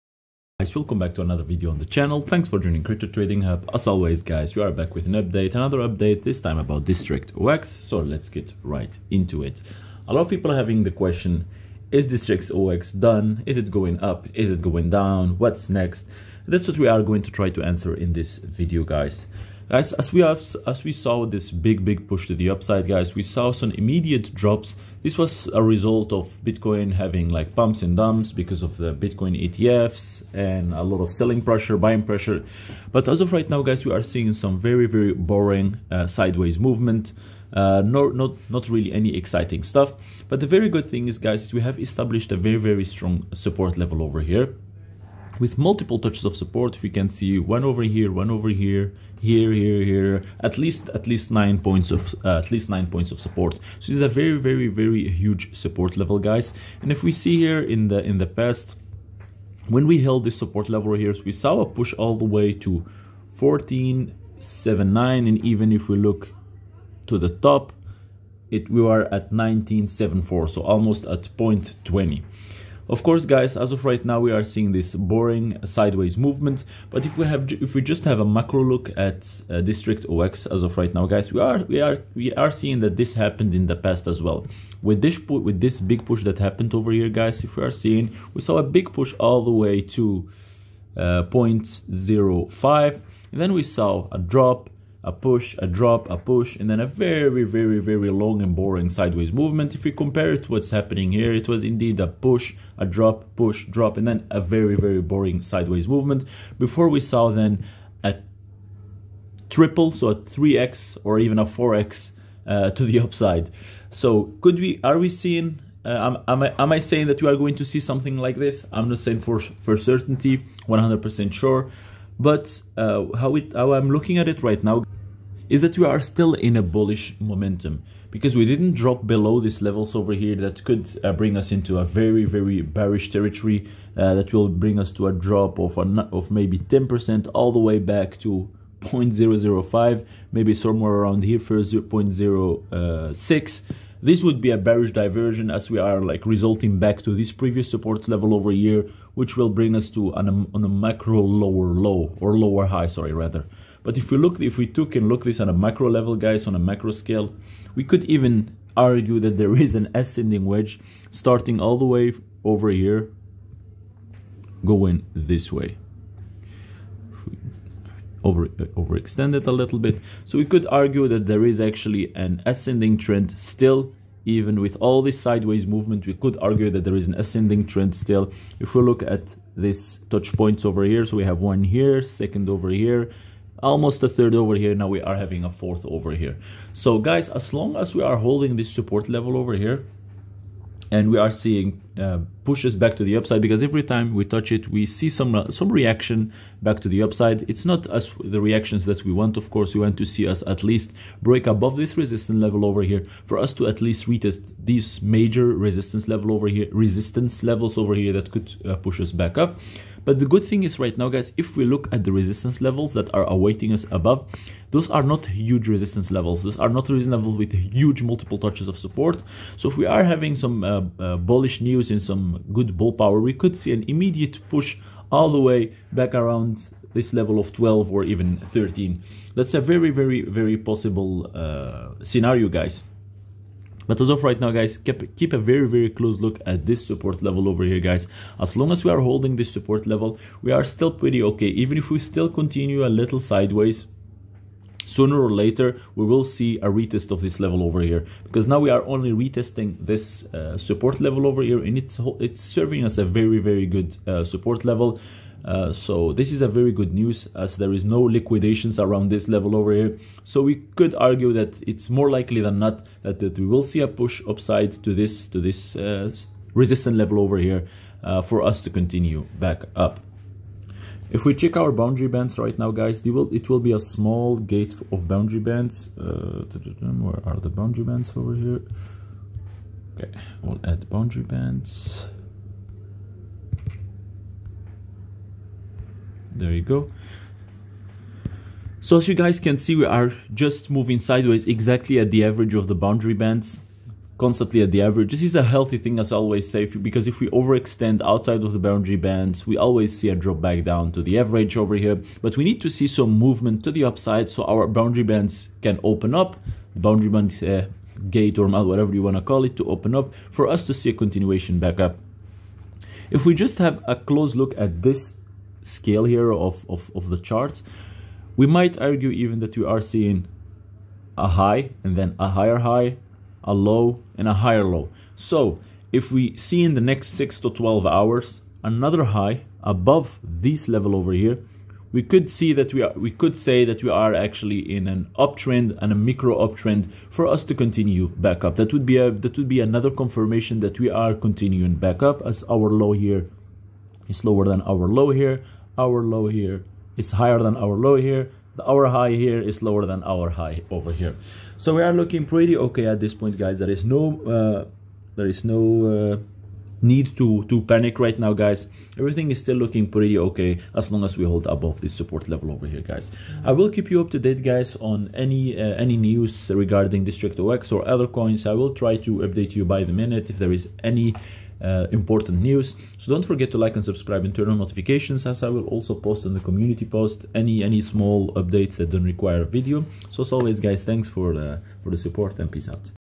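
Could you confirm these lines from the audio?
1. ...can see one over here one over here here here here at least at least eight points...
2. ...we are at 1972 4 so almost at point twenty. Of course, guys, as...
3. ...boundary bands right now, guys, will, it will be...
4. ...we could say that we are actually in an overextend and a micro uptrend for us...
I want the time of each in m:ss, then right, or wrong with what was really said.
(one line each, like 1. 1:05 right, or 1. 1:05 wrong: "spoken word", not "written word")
1. 0:46 wrong: "nine", not "eight"
2. 1:08 wrong: "1974", not "1972"
3. 4:31 right
4. 5:32 wrong: "uptrend", not "overextend".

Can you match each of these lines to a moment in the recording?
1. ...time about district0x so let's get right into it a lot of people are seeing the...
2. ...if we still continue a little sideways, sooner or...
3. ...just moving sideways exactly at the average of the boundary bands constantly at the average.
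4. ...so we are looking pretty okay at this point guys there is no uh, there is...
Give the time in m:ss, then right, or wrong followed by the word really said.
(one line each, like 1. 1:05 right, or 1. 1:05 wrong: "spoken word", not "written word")
1. 0:06 wrong: "having", not "seeing"
2. 4:01 right
3. 4:50 right
4. 5:51 right.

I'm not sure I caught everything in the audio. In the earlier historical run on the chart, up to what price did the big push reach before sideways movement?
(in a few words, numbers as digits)
0.05.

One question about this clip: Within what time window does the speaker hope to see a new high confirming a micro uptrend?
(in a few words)
6 to 12 hours.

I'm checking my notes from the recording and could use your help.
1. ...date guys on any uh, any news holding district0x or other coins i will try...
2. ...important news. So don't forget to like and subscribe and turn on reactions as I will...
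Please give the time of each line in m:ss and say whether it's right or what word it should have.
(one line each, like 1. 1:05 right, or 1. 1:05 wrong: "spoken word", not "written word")
1. 6:04 wrong: "regarding", not "holding"
2. 6:11 wrong: "notifications", not "reactions".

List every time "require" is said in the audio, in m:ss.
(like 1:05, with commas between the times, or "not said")
6:19.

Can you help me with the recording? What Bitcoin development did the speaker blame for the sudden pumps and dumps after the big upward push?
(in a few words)
Bitcoin ETFs.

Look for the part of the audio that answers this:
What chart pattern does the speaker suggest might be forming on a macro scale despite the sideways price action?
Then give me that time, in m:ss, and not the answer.
2:39.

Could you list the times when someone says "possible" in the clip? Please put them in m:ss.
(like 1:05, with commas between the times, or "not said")
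3:50.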